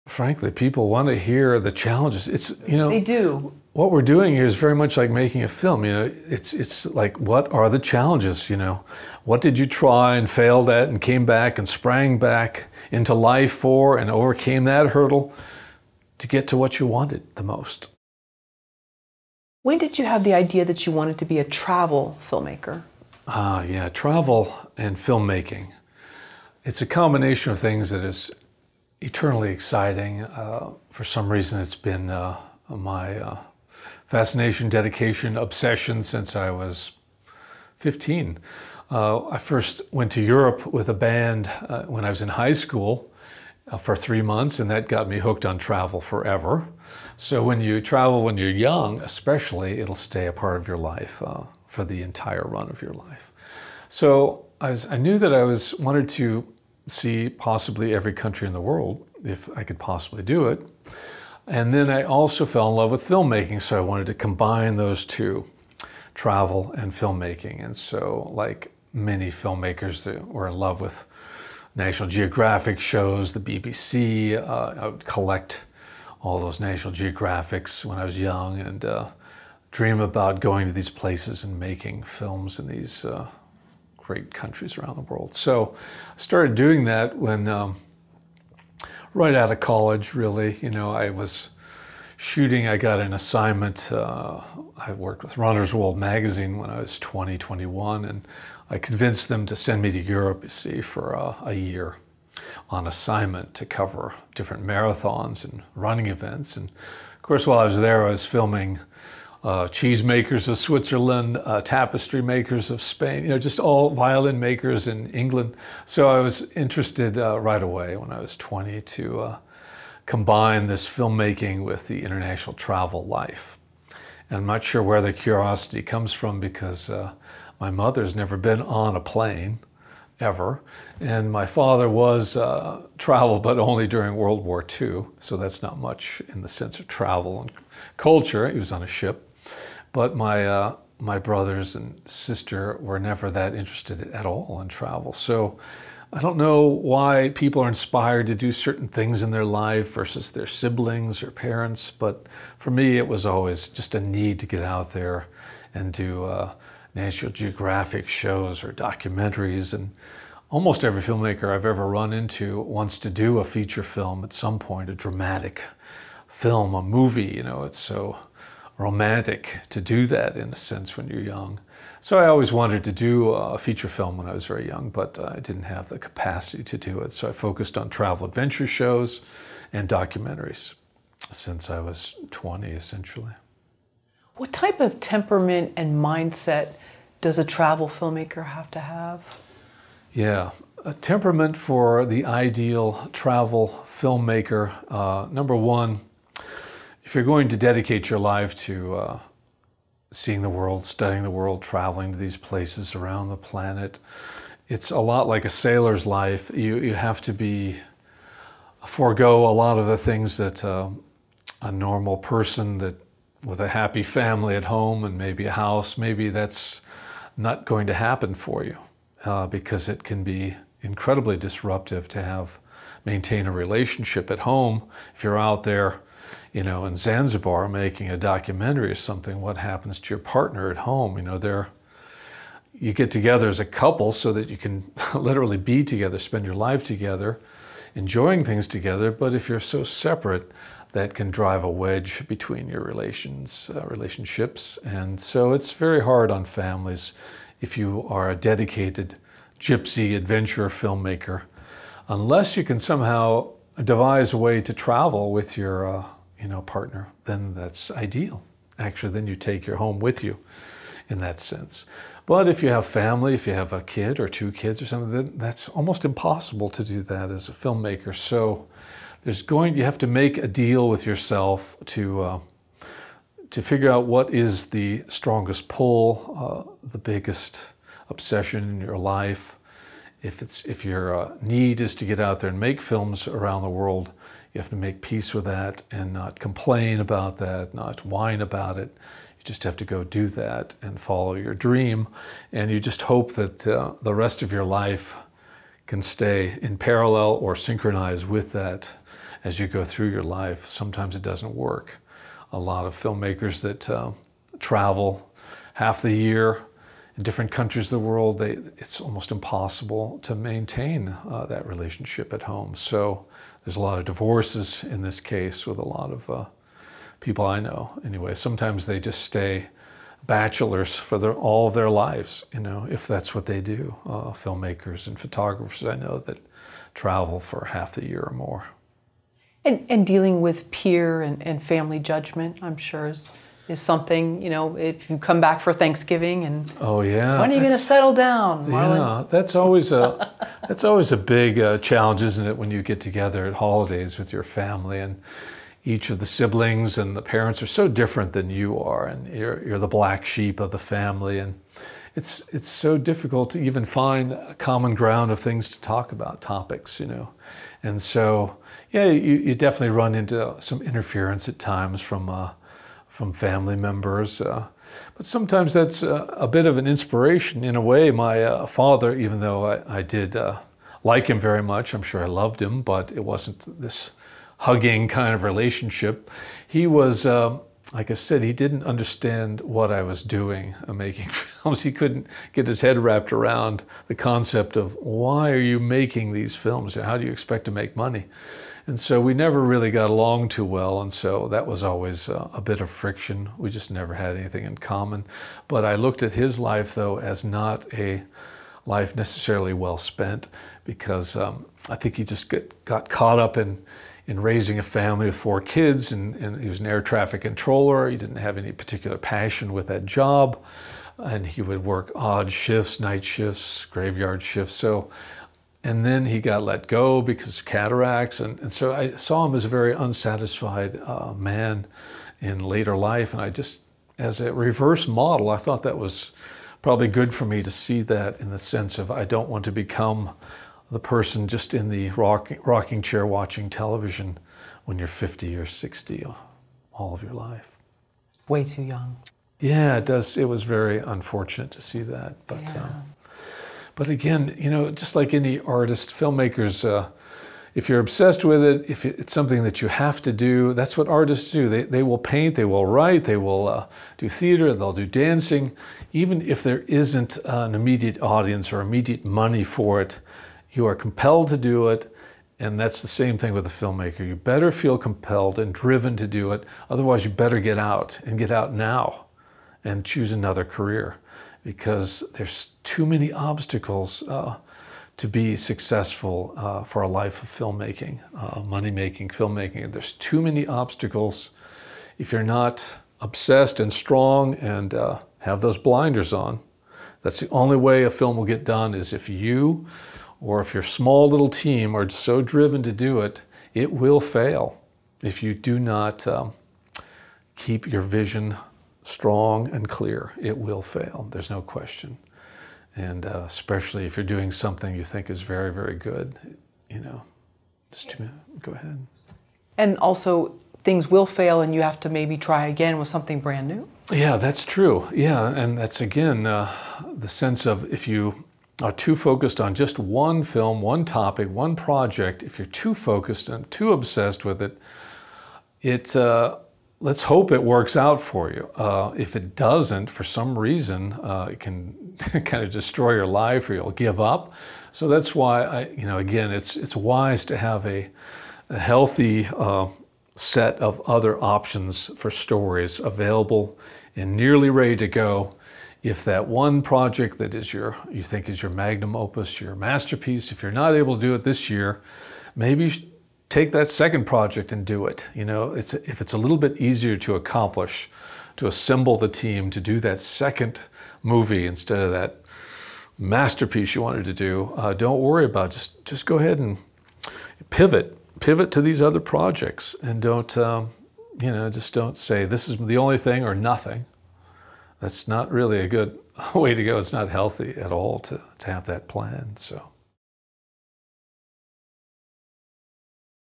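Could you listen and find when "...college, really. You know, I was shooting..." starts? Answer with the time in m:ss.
1:29.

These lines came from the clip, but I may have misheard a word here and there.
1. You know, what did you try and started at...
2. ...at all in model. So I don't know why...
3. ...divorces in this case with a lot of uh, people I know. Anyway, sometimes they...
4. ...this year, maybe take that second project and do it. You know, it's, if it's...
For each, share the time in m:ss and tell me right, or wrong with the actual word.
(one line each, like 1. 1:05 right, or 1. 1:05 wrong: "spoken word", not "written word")
1. 0:08 wrong: "failed", not "started"
2. 2:24 wrong: "travel", not "model"
3. 5:14 right
4. 9:11 right.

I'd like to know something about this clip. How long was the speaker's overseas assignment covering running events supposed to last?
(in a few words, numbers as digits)
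a year.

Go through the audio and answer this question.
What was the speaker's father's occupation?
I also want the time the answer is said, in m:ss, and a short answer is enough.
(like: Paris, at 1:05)
air traffic controller, at 6:46.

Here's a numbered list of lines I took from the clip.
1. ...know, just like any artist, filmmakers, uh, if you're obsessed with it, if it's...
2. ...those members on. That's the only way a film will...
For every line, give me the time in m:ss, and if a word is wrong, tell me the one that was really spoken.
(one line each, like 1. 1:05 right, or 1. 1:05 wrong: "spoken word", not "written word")
1. 7:24 right
2. 8:05 wrong: "blinders", not "members".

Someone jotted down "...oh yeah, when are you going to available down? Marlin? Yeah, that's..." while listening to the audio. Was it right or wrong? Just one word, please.
wrong.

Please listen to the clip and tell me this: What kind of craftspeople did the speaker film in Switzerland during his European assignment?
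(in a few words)
cheese makers.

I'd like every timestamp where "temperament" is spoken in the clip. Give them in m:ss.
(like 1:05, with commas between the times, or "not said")
3:04, 3:10.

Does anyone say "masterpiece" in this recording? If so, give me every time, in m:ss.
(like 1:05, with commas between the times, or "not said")
9:09, 9:23.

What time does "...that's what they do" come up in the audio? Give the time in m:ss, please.
5:23.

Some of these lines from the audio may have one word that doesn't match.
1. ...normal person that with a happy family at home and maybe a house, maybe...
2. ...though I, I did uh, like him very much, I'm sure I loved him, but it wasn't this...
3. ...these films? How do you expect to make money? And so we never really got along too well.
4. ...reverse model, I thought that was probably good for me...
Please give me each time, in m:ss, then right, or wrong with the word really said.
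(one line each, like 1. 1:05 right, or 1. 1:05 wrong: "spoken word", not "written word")
1. 3:31 right
2. 6:09 right
3. 6:26 right
4. 7:04 right.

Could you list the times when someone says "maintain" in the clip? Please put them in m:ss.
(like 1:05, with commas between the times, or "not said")
3:43, 5:10.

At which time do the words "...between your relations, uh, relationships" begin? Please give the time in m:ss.
4:02.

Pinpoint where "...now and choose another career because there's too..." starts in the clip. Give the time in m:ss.
7:48.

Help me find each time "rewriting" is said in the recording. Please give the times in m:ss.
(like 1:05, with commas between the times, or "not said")
not said.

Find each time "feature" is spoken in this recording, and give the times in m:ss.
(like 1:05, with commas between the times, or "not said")
2:43, 2:53.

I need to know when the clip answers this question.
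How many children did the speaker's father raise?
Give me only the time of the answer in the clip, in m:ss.
6:45.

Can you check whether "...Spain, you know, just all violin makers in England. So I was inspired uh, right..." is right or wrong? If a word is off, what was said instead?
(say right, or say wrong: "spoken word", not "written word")
wrong: "interested", not "inspired".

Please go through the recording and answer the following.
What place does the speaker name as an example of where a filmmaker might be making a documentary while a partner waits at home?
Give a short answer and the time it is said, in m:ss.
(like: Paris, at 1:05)
Zanzibar, at 3:46.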